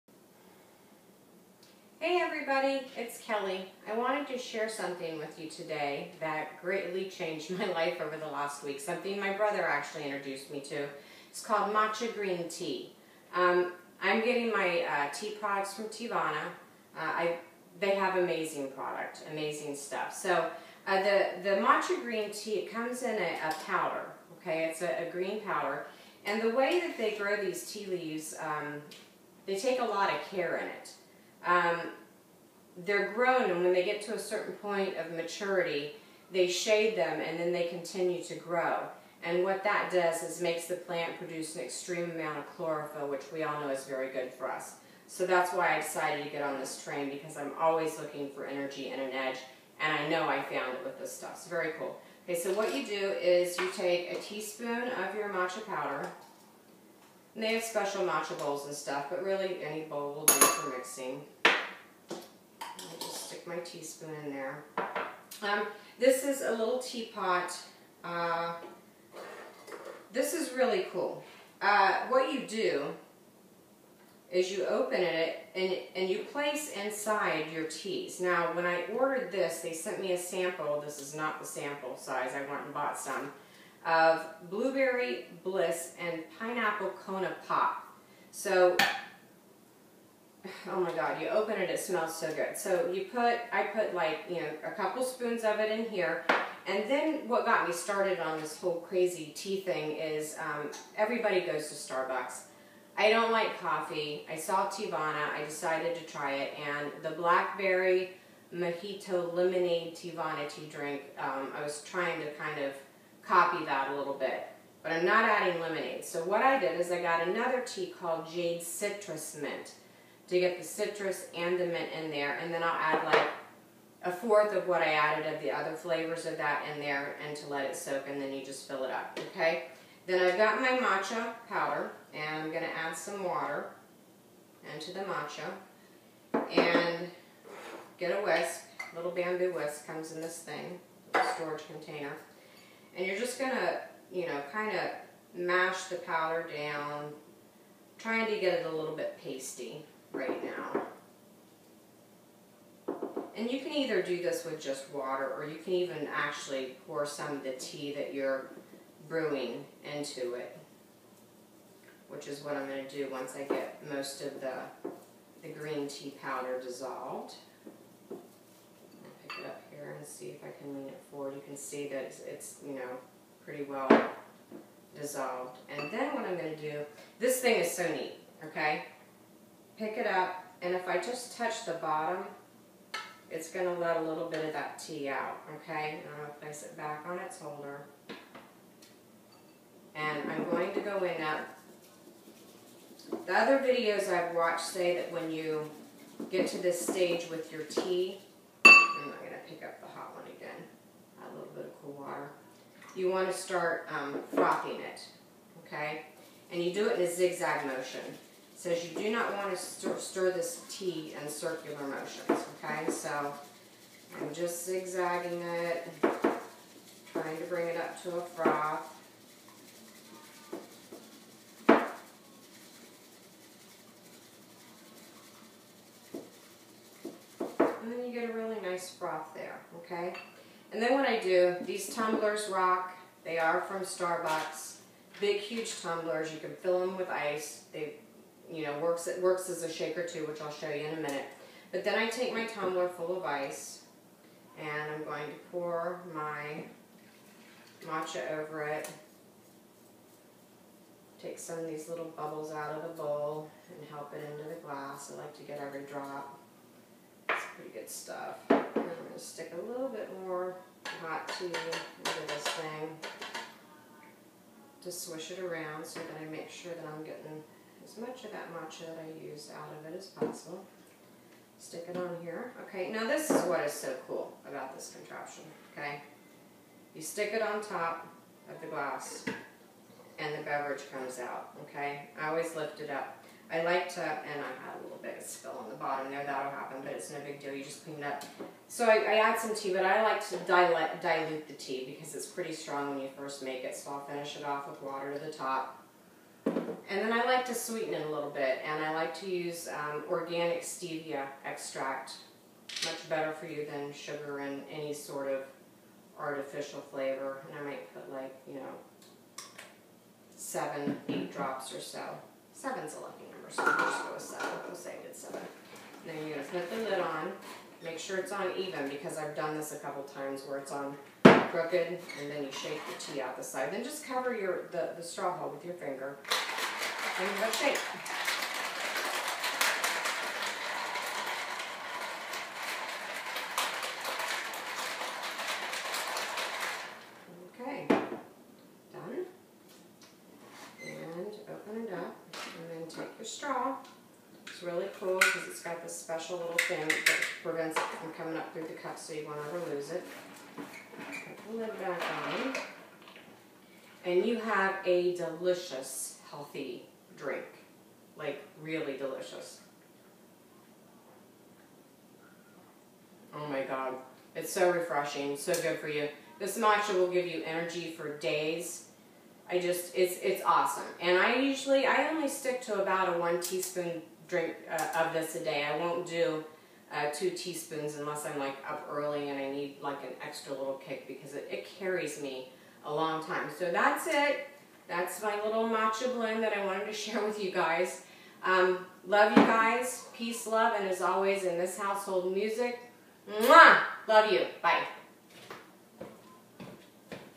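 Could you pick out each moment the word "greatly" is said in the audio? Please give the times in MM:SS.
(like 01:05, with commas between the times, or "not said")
00:06.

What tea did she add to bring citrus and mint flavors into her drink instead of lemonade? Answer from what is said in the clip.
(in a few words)
Jade Citrus Mint.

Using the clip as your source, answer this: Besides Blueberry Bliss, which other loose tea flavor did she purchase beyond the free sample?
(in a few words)
Pineapple Kona Pop.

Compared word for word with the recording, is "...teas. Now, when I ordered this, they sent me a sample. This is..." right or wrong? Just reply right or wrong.
right.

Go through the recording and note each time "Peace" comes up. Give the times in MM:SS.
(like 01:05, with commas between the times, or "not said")
06:30.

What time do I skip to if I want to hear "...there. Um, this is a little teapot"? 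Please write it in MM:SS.
01:04.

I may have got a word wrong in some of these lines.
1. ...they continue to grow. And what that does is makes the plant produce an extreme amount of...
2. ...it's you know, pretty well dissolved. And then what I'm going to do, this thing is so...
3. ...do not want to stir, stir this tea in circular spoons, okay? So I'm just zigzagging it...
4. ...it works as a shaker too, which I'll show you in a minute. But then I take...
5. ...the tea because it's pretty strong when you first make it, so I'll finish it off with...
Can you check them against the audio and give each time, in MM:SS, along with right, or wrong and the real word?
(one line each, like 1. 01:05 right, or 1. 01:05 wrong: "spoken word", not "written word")
1. 00:37 right
2. 02:52 right
3. 03:28 wrong: "motions", not "spoons"
4. 03:59 right
5. 04:51 right.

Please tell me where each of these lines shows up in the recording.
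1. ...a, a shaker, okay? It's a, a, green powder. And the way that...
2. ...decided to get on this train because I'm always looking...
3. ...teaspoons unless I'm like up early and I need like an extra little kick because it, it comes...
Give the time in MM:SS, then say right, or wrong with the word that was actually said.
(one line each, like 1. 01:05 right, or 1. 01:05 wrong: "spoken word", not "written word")
1. 00:23 wrong: "powder", not "shaker"
2. 00:45 right
3. 06:17 wrong: "carries", not "comes".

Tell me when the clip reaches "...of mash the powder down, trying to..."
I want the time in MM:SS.
02:24.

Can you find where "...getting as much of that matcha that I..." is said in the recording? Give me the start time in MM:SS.
04:27.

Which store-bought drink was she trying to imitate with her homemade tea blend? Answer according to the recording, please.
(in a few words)
blackberry mojito lemonade.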